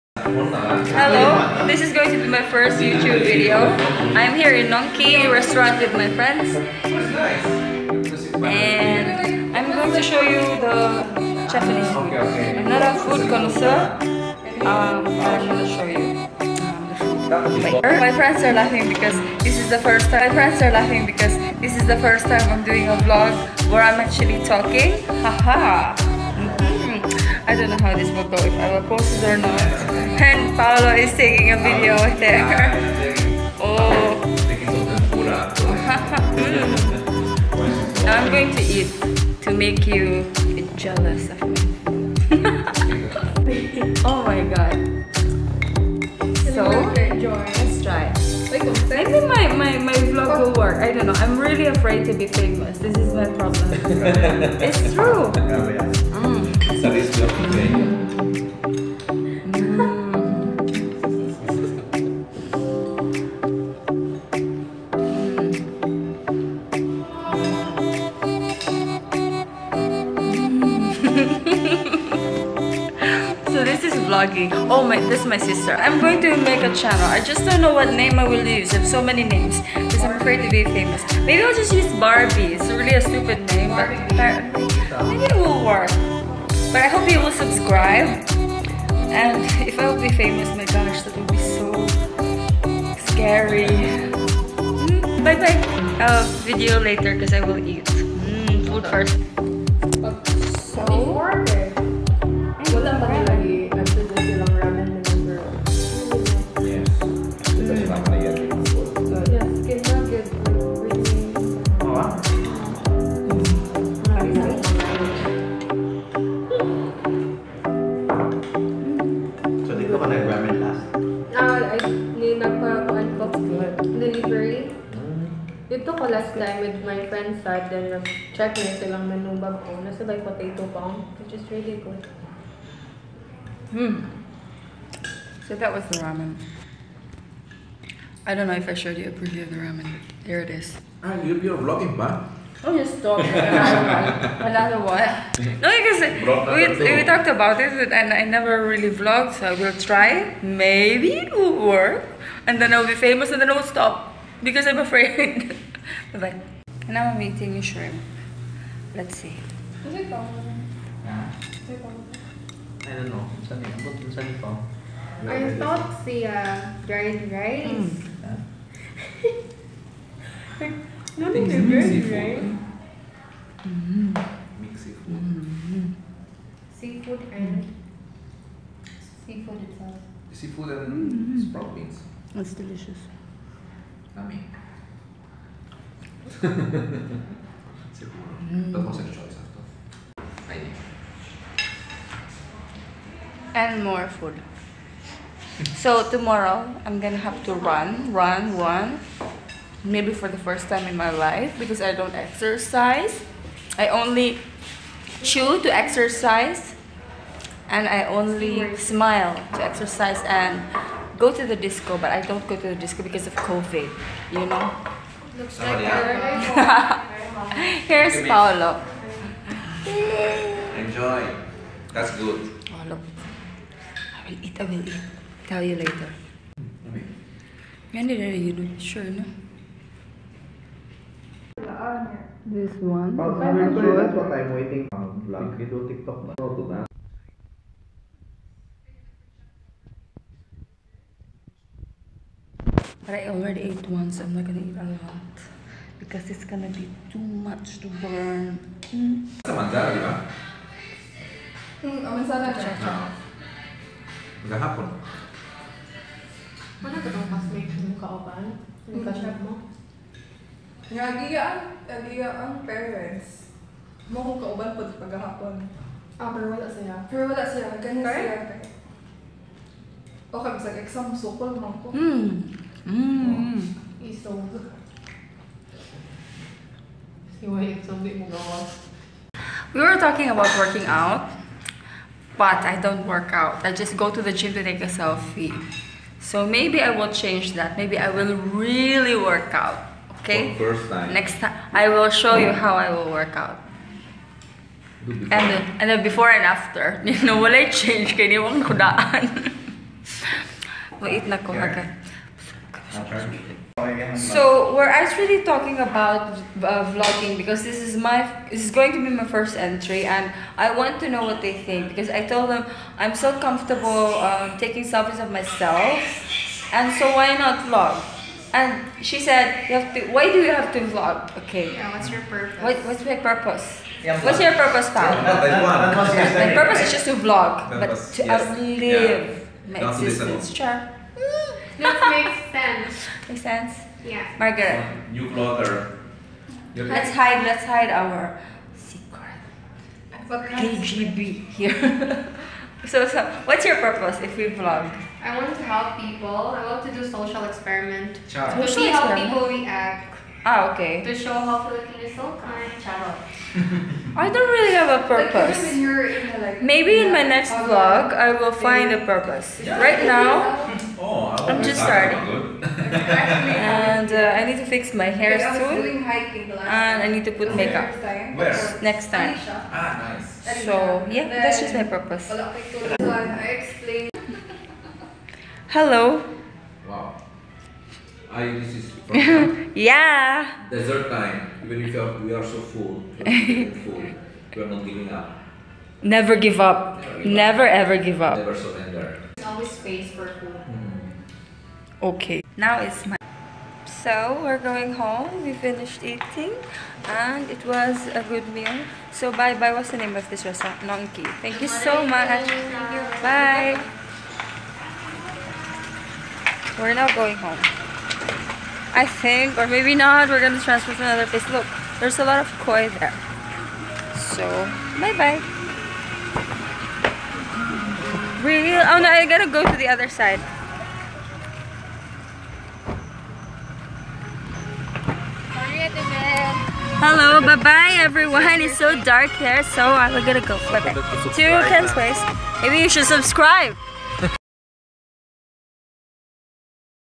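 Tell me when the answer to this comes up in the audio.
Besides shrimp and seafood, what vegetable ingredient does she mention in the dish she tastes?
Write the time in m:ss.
3:01.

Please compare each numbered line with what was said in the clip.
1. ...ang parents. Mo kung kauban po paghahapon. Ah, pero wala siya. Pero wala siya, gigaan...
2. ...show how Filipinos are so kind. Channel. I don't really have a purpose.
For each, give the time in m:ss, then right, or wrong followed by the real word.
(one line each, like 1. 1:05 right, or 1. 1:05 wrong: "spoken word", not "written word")
1. 4:22 wrong: "ganyan", not "gigaan"
2. 5:51 right.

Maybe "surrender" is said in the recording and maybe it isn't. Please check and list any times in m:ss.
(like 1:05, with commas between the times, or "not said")
6:28.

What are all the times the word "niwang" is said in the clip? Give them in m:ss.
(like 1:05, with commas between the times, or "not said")
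4:58.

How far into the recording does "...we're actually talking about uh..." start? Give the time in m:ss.
5:04.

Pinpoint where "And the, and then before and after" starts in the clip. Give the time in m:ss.
4:55.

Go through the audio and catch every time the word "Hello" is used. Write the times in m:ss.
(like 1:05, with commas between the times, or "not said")
0:00, 6:15, 7:07.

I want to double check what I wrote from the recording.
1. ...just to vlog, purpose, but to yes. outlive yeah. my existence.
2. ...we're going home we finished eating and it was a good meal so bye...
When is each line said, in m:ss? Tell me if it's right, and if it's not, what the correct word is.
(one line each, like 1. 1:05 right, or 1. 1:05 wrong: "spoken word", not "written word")
1. 5:26 right
2. 6:34 right.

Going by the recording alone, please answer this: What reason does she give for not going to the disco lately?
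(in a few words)
COVID.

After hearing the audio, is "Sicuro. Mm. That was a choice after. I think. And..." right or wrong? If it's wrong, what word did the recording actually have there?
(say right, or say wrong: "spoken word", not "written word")
right.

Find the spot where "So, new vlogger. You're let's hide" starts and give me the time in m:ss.
5:34.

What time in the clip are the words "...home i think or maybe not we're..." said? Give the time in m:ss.
6:47.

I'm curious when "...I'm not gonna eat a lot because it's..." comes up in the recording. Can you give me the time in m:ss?
4:04.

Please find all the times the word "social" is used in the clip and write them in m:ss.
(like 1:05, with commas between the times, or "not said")
5:47.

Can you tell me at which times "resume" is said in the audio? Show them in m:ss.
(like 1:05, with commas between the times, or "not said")
not said.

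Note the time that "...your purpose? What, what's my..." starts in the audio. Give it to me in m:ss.
5:22.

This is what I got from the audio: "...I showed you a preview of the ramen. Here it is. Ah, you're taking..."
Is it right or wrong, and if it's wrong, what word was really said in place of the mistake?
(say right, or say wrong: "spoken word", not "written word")
wrong: "vlogging", not "taking".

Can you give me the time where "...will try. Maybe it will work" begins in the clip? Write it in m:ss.
2:29.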